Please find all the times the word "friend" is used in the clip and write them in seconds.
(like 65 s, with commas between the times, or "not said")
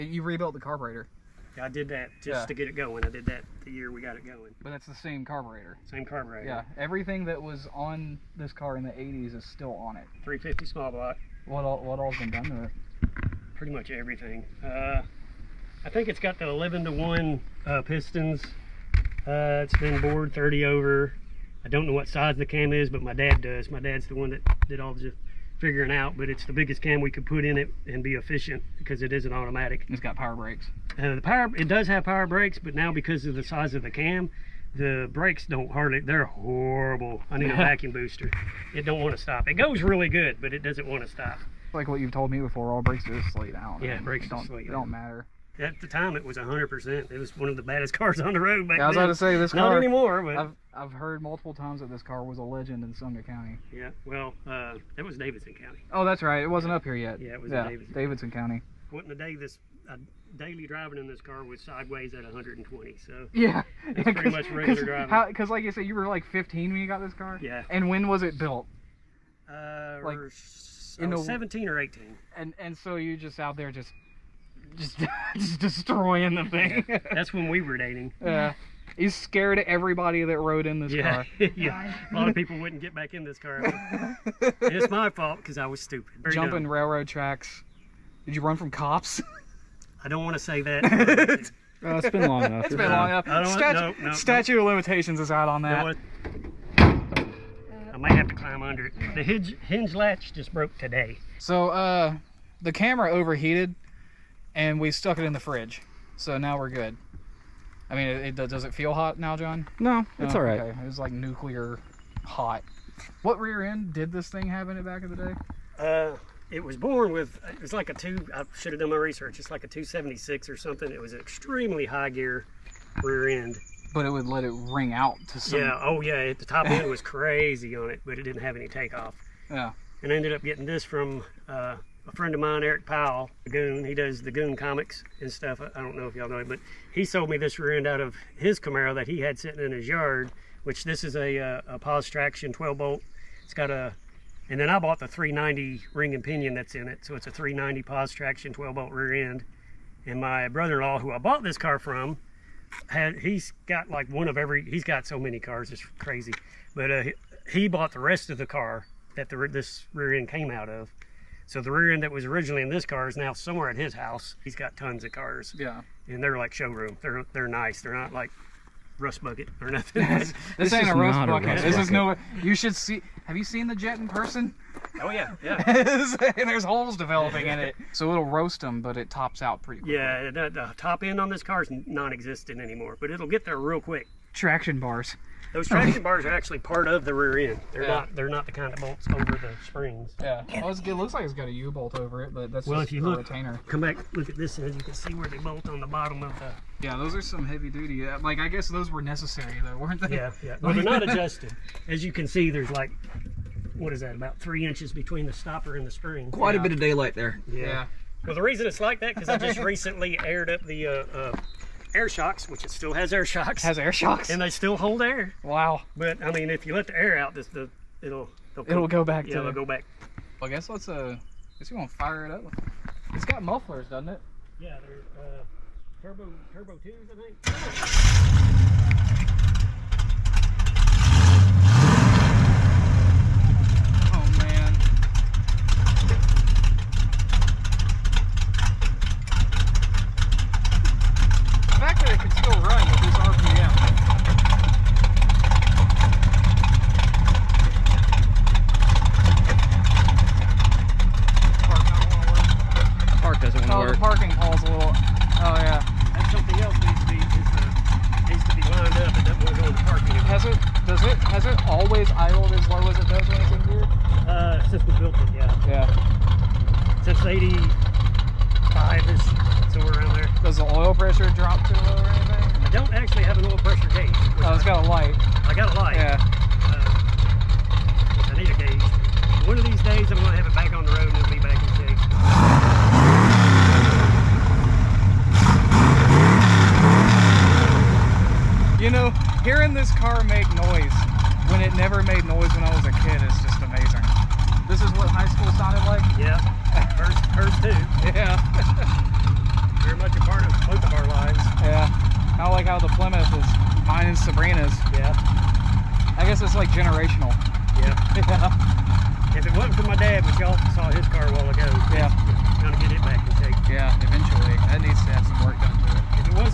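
132 s.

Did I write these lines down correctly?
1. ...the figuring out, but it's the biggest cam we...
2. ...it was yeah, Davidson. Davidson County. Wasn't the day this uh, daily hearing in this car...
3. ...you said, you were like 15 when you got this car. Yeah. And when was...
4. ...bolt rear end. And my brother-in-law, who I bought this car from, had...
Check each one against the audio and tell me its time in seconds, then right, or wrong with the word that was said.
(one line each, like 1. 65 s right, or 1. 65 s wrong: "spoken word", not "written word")
1. 24 s right
2. 57 s wrong: "driving", not "hearing"
3. 65 s right
4. 148 s right.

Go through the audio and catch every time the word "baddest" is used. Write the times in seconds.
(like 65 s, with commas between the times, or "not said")
47 s.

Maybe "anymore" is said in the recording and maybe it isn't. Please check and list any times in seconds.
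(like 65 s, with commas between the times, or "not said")
49 s, 182 s.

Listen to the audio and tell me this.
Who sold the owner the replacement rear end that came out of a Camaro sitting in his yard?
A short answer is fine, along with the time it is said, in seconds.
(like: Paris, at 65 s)
Eric Powell, at 132 s.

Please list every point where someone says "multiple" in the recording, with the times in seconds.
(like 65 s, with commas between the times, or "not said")
51 s.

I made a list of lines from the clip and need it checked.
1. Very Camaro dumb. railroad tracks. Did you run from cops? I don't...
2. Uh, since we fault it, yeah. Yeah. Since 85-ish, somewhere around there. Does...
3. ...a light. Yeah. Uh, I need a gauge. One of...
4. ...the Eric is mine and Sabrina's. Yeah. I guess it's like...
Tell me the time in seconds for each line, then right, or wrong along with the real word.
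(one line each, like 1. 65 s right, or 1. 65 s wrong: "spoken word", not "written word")
1. 86 s wrong: "Jumping", not "Camaro"
2. 264 s wrong: "built", not "fault"
3. 275 s right
4. 302 s wrong: "Plymouth", not "Eric".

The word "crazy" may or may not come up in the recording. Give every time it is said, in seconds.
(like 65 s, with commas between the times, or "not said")
127 s, 155 s.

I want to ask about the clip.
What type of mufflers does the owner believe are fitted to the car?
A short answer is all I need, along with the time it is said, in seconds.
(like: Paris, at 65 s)
Turbo twos, at 226 s.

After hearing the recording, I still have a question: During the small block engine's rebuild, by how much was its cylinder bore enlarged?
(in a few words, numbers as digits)
30 over.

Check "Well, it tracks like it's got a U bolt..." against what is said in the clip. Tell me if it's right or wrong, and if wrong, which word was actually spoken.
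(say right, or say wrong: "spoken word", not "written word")
wrong: "looks", not "tracks".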